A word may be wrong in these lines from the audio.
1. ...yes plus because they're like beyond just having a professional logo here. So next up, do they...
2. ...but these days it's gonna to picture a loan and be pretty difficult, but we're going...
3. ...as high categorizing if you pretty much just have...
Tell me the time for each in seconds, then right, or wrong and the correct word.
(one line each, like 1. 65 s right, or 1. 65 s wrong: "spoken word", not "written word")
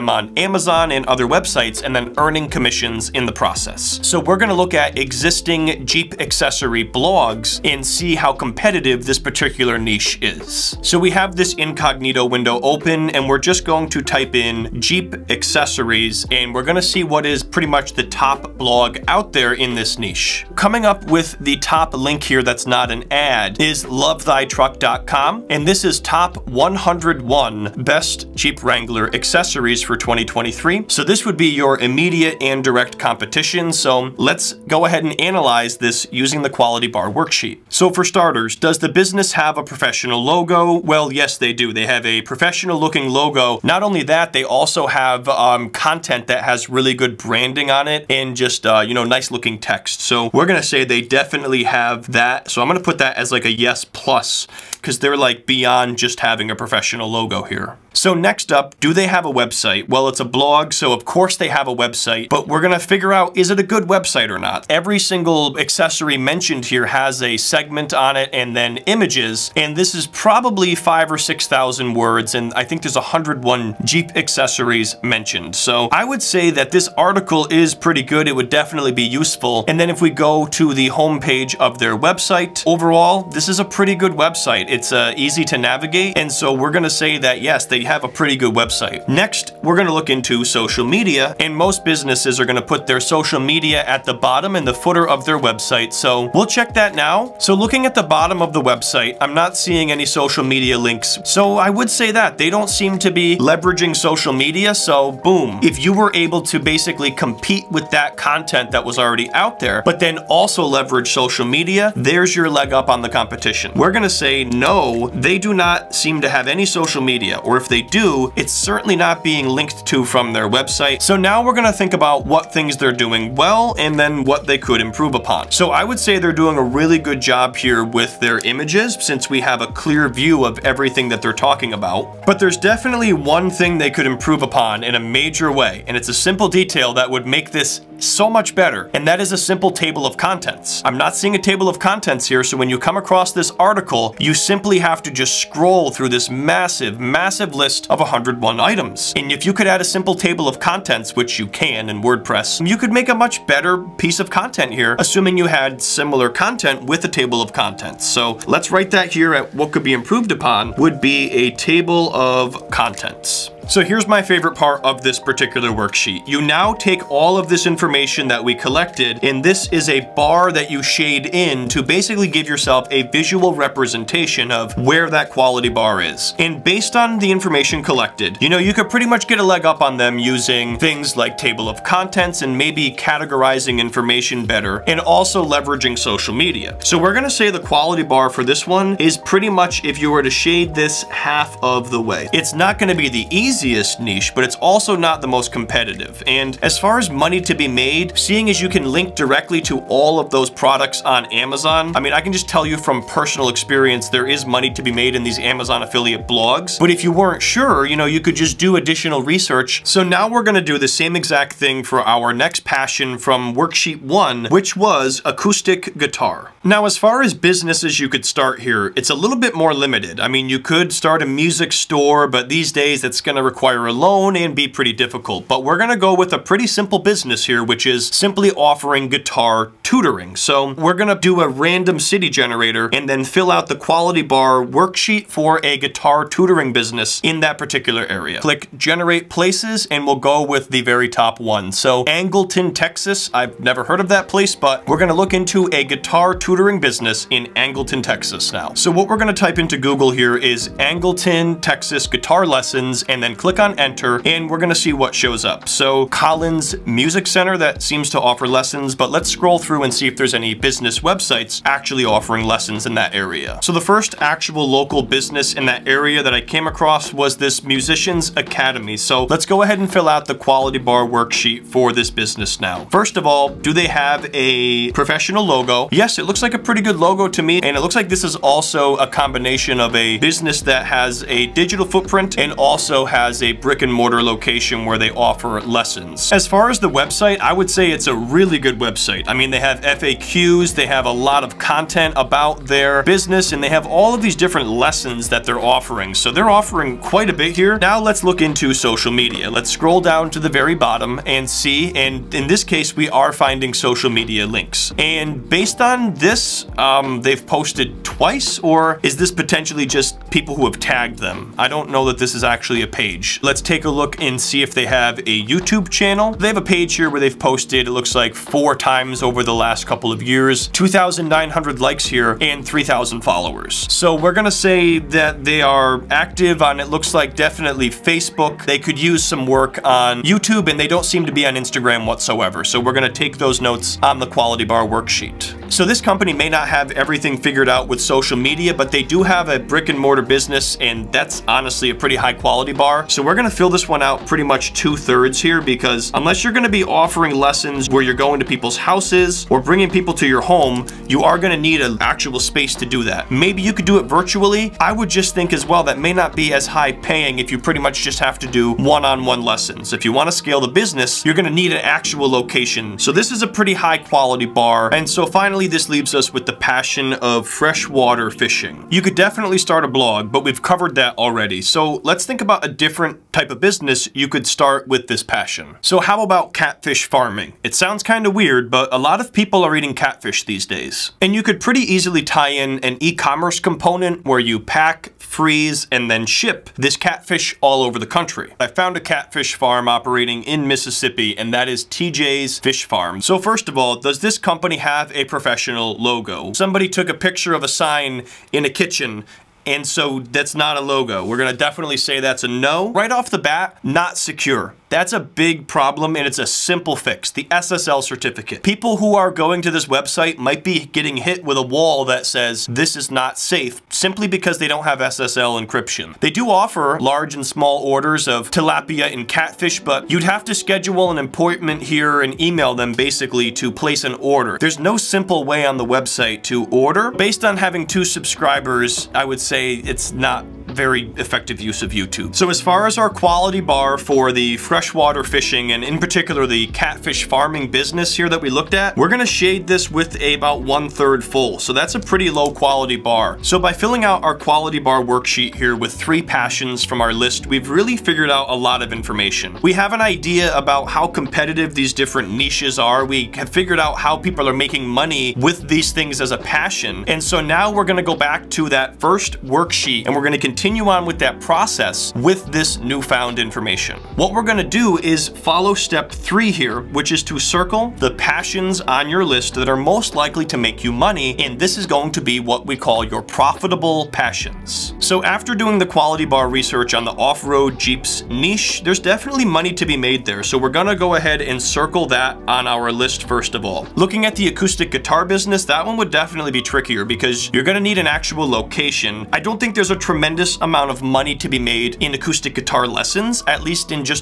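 1. 53 s right
2. 222 s wrong: "require", not "picture"
3. 356 s wrong: "paying", not "categorizing".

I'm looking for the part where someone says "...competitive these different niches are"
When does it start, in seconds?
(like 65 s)
451 s.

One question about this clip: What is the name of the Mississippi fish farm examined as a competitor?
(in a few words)
TJ's Fish Farm.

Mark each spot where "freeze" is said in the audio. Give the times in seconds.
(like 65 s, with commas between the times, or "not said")
385 s.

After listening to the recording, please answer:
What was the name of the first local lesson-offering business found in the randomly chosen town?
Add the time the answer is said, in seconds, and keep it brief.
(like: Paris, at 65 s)
Musicians Academy, at 267 s.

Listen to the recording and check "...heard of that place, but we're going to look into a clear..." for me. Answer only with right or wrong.
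wrong.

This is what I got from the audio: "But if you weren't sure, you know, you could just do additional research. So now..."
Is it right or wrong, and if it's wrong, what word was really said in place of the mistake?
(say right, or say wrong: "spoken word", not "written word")
right.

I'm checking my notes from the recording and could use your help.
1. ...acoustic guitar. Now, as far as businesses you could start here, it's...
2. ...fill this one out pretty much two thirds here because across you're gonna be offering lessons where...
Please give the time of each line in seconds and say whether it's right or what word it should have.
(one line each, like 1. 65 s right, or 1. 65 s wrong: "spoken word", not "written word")
1. 215 s right
2. 343 s wrong: "unless", not "across".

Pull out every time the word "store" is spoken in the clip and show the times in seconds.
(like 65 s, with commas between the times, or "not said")
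221 s.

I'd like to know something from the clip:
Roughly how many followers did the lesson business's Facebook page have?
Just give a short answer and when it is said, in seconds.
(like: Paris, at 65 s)
3,000, at 322 s.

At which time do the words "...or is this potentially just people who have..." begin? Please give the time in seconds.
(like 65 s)
308 s.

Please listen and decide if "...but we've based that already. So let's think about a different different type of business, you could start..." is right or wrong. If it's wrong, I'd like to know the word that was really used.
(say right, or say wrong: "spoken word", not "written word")
wrong: "covered", not "based".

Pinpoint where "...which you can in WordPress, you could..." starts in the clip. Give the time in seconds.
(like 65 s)
151 s.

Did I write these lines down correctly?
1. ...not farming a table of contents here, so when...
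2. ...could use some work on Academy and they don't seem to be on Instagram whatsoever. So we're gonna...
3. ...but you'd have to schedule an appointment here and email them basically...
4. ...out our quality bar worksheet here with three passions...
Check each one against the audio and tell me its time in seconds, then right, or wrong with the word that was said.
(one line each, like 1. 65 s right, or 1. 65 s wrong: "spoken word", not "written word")
1. 140 s wrong: "seeing", not "farming"
2. 328 s wrong: "YouTube", not "Academy"
3. 419 s right
4. 444 s right.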